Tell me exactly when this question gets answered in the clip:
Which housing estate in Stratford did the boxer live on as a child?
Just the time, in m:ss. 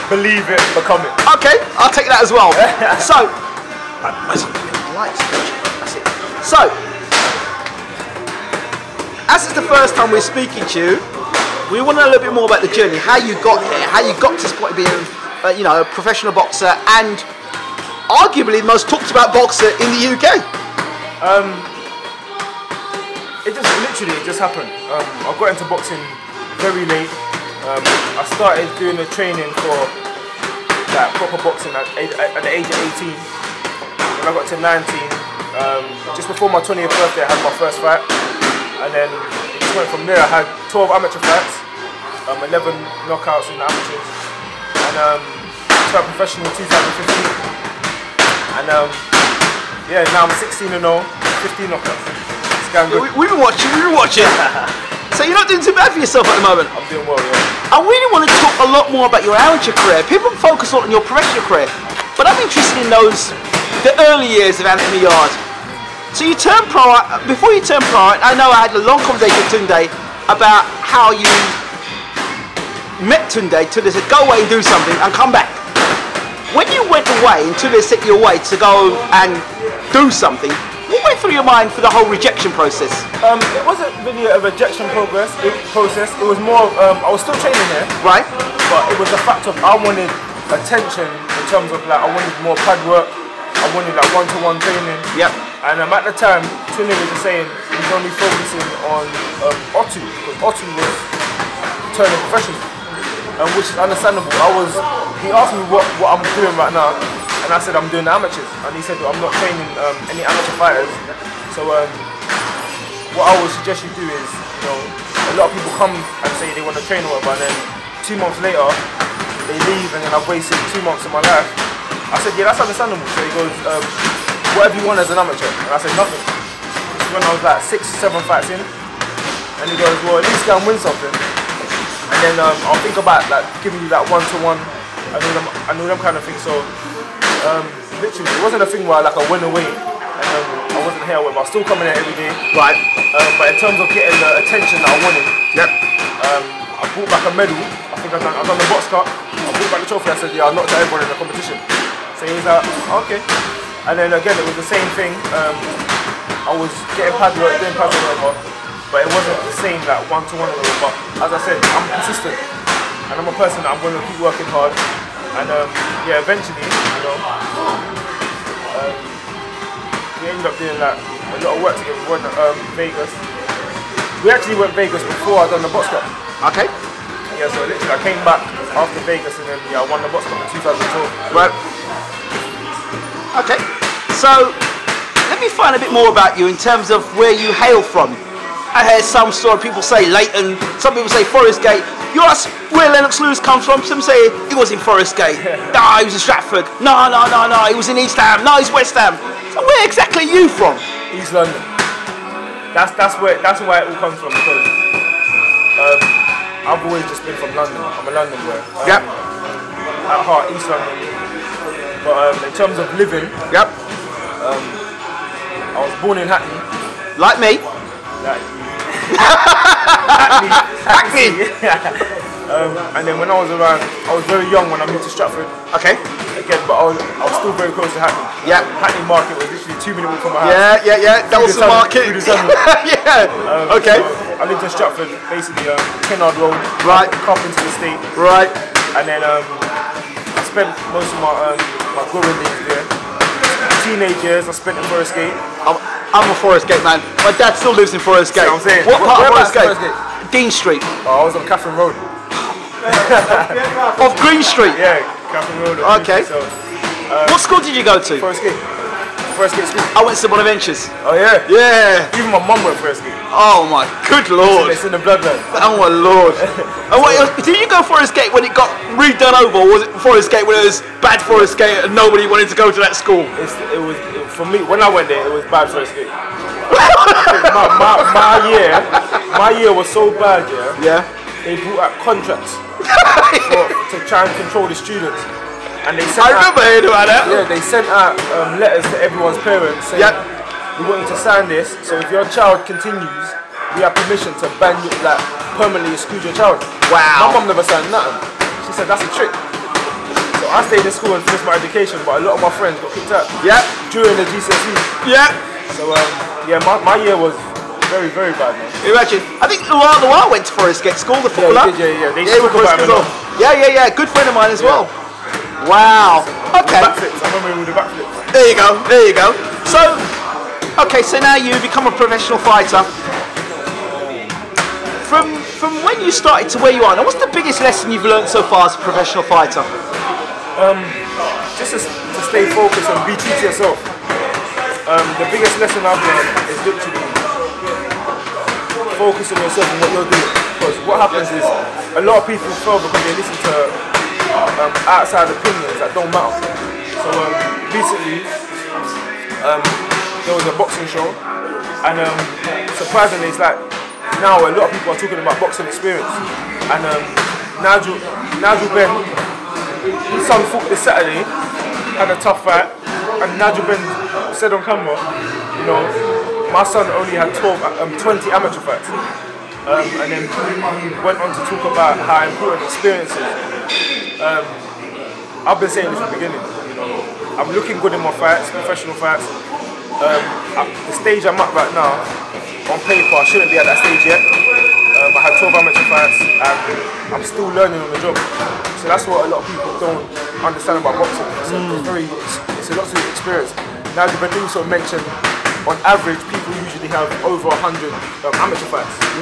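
3:57.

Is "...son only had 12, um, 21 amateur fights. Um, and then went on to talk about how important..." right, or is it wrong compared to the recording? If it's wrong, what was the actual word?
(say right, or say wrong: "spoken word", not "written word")
wrong: "20", not "21".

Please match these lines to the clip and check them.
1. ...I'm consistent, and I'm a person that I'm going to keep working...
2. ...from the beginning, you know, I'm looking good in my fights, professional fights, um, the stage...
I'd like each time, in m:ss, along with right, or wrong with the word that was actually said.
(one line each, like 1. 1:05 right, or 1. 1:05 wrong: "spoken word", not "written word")
1. 2:41 right
2. 6:15 right.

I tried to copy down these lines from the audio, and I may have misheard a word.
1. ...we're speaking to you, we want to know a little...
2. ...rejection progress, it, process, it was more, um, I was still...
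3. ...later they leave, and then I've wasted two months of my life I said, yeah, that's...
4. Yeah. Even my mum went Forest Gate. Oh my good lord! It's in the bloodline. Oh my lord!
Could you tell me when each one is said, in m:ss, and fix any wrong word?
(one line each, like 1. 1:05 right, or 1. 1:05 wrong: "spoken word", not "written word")
1. 0:10 right
2. 1:24 right
3. 1:58 right
4. 4:21 right.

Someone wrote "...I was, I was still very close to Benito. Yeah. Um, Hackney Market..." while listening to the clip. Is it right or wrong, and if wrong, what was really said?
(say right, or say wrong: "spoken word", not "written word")
wrong: "Hackney", not "Benito".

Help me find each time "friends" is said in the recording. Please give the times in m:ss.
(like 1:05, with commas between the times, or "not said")
5:02, 5:14.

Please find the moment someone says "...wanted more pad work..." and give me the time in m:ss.
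1:32.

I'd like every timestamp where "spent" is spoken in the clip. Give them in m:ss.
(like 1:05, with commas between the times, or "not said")
4:00, 4:04.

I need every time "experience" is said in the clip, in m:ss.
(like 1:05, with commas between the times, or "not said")
5:55, 6:12, 6:33.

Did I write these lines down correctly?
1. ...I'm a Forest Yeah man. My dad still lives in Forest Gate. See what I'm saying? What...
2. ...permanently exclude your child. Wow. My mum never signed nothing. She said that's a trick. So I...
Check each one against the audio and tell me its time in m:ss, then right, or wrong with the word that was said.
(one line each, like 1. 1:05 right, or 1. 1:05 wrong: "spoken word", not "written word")
1. 4:06 wrong: "Gate", not "Yeah"
2. 4:55 right.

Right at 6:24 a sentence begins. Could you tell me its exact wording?
Um, I had 12 amateur fights and I'm still learning on the job.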